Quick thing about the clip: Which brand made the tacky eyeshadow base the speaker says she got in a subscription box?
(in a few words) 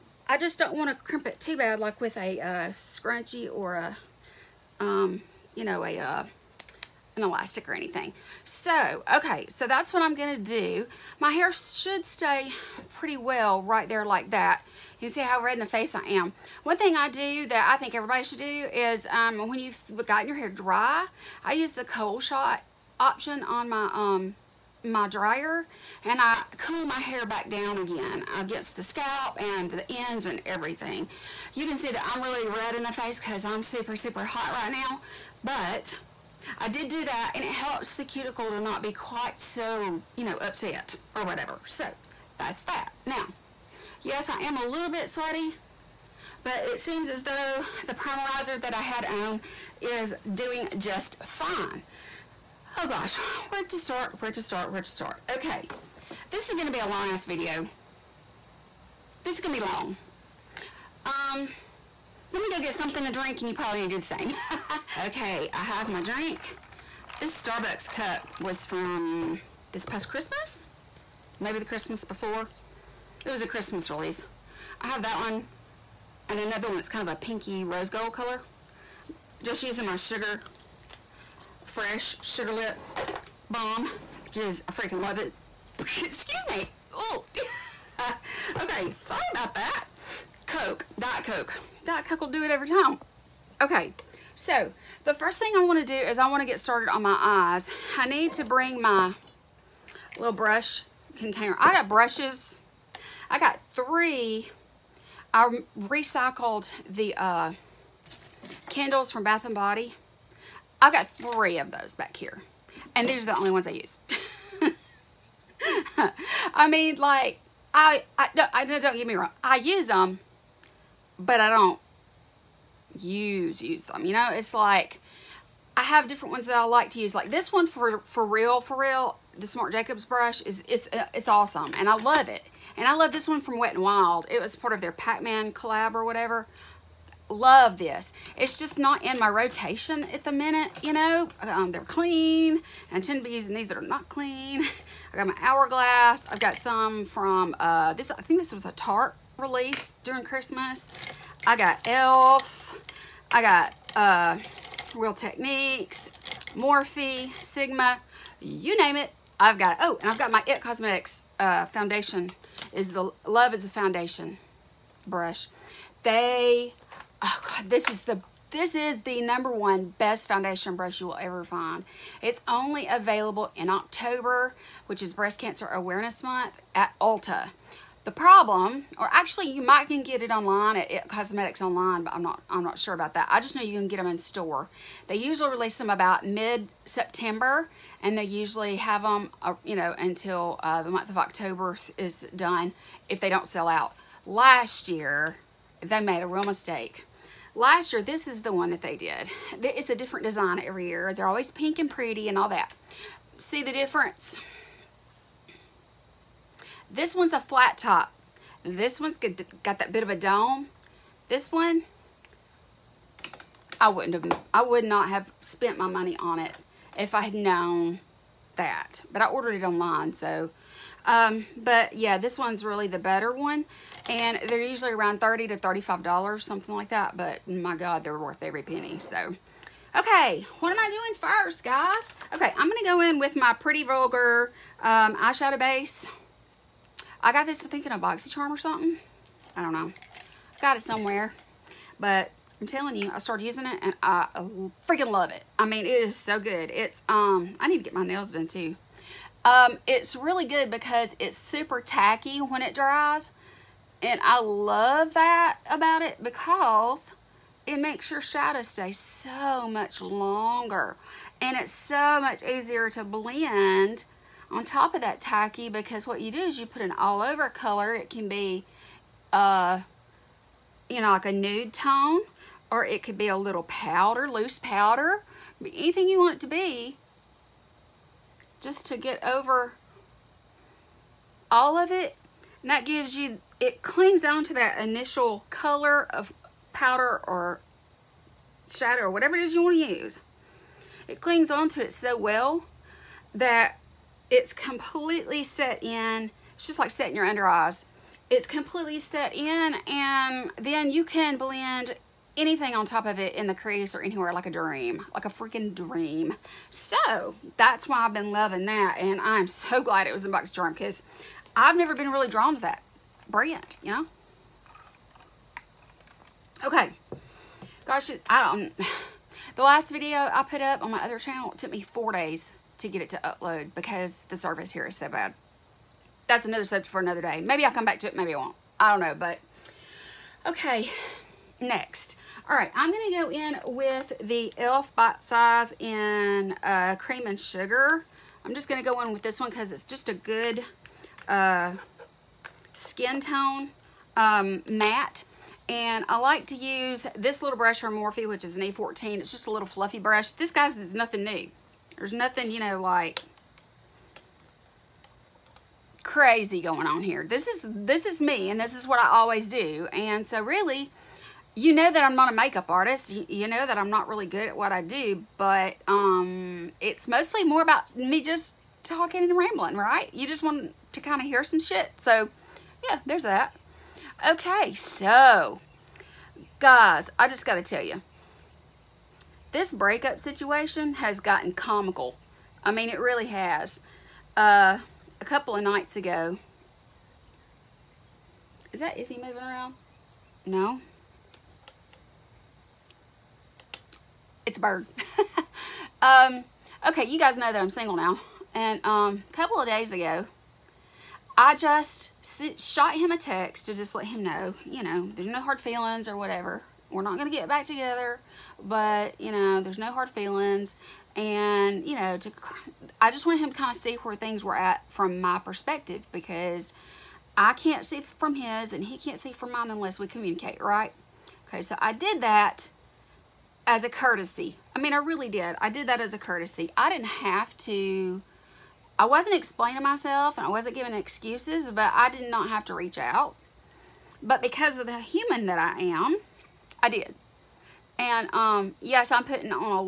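Pretty Vulgar.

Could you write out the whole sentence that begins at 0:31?
You can see that I'm really red in the face because I'm super, super hot right now.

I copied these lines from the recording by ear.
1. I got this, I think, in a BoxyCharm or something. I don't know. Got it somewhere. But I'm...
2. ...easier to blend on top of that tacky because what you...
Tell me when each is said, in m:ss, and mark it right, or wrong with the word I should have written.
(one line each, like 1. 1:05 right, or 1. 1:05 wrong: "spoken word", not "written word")
1. 3:57 right
2. 4:22 right.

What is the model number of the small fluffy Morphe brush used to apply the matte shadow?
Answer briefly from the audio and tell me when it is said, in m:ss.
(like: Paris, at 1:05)
A14, at 5:48.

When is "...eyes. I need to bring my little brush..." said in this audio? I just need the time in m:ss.
1:37.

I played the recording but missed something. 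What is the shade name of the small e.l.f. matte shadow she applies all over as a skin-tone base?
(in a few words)
Cream and Sugar.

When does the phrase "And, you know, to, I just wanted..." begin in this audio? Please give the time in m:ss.
6:51.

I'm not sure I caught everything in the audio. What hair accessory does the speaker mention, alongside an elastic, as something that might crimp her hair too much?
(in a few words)
Scrunchie.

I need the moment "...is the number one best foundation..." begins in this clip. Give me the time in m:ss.
2:48.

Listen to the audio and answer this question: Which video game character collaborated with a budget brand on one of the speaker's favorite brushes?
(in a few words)
Pac-Man.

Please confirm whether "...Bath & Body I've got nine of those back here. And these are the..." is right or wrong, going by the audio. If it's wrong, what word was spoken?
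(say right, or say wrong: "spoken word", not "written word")
wrong: "three", not "nine".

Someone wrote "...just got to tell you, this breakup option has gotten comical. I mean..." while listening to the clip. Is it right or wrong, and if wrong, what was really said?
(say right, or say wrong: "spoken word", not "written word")
wrong: "situation", not "option".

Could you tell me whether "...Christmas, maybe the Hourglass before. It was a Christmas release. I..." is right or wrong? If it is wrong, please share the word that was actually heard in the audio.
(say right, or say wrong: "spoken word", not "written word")
wrong: "Christmas", not "Hourglass".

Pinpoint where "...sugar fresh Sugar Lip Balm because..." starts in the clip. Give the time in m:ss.
1:19.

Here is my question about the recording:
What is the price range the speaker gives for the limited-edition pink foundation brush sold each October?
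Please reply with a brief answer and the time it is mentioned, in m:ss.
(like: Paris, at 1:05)
$30 to $35, at 3:45.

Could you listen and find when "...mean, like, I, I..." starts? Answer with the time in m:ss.
1:56.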